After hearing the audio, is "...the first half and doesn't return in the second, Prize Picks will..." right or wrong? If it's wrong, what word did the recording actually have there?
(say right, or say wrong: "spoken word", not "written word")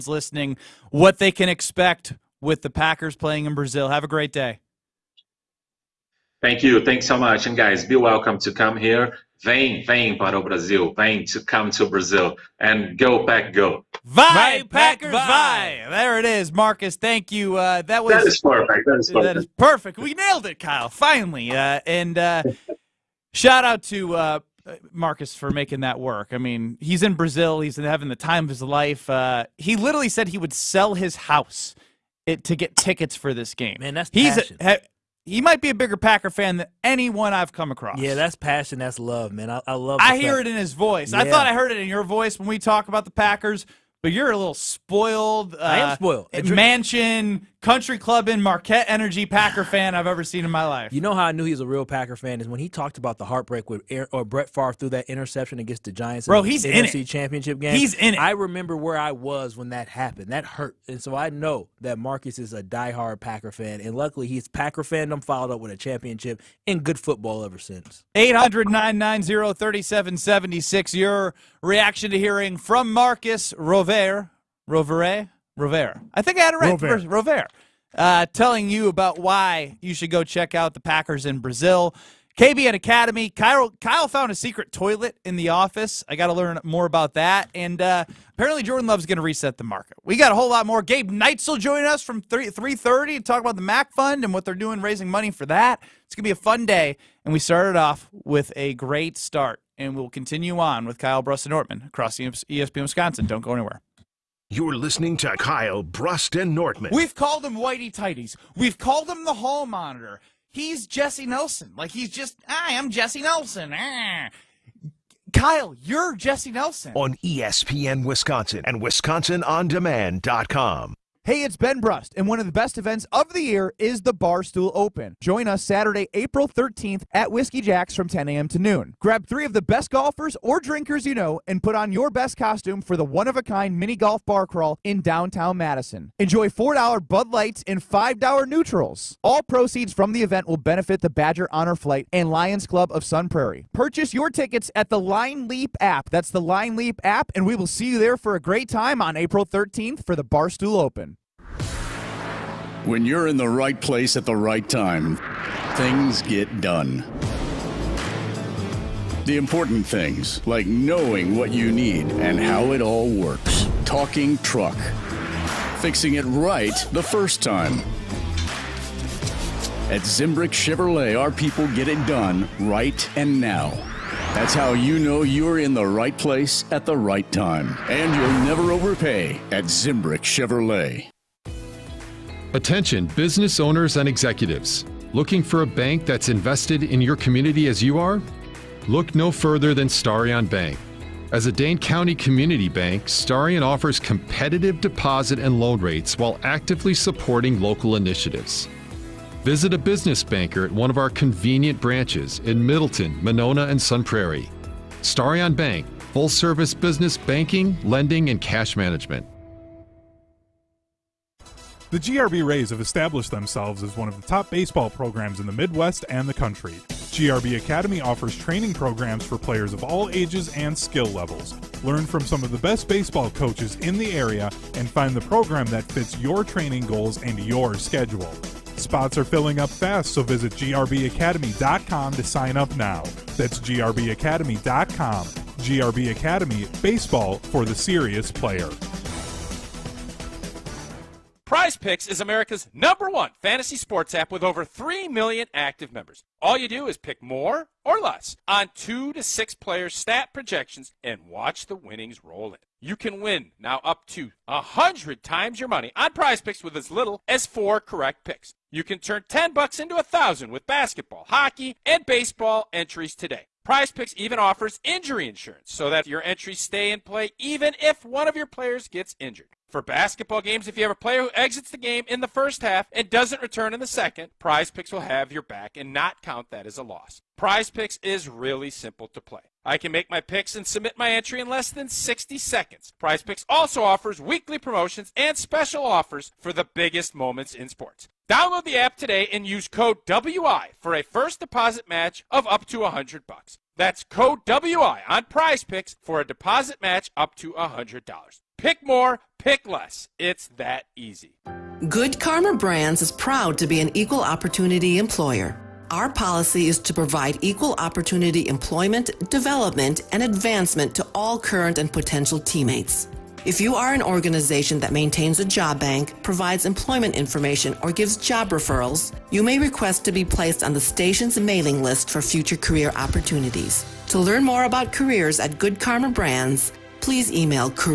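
right.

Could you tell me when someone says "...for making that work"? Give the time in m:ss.
0:25.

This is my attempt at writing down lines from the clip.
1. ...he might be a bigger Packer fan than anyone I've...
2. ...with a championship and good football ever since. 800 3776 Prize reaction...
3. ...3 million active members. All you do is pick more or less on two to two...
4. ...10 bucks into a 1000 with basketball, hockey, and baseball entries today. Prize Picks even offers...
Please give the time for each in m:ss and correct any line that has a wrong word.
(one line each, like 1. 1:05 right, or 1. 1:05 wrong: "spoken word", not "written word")
1. 0:35 right
2. 1:05 wrong: "Your", not "Prize"
3. 4:04 wrong: "six", not "two"
4. 4:19 right.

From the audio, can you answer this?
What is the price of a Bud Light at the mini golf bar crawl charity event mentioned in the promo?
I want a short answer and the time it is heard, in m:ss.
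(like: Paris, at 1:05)
$4, at 2:16.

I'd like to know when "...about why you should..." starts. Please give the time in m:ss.
1:18.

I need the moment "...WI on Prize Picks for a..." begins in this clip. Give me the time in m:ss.
4:54.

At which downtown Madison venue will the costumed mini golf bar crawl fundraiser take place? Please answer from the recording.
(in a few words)
Whiskey Jack's.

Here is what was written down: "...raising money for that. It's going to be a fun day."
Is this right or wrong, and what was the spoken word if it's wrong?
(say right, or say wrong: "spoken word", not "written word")
right.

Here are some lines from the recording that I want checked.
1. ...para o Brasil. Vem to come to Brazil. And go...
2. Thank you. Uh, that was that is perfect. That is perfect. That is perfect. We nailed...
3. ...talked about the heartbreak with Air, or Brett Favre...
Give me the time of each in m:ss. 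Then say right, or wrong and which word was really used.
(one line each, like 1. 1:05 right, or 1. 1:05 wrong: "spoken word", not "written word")
1. 0:10 right
2. 0:16 right
3. 0:52 right.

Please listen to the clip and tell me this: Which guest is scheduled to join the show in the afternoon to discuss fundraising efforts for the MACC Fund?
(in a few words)
Gabe Neitzel.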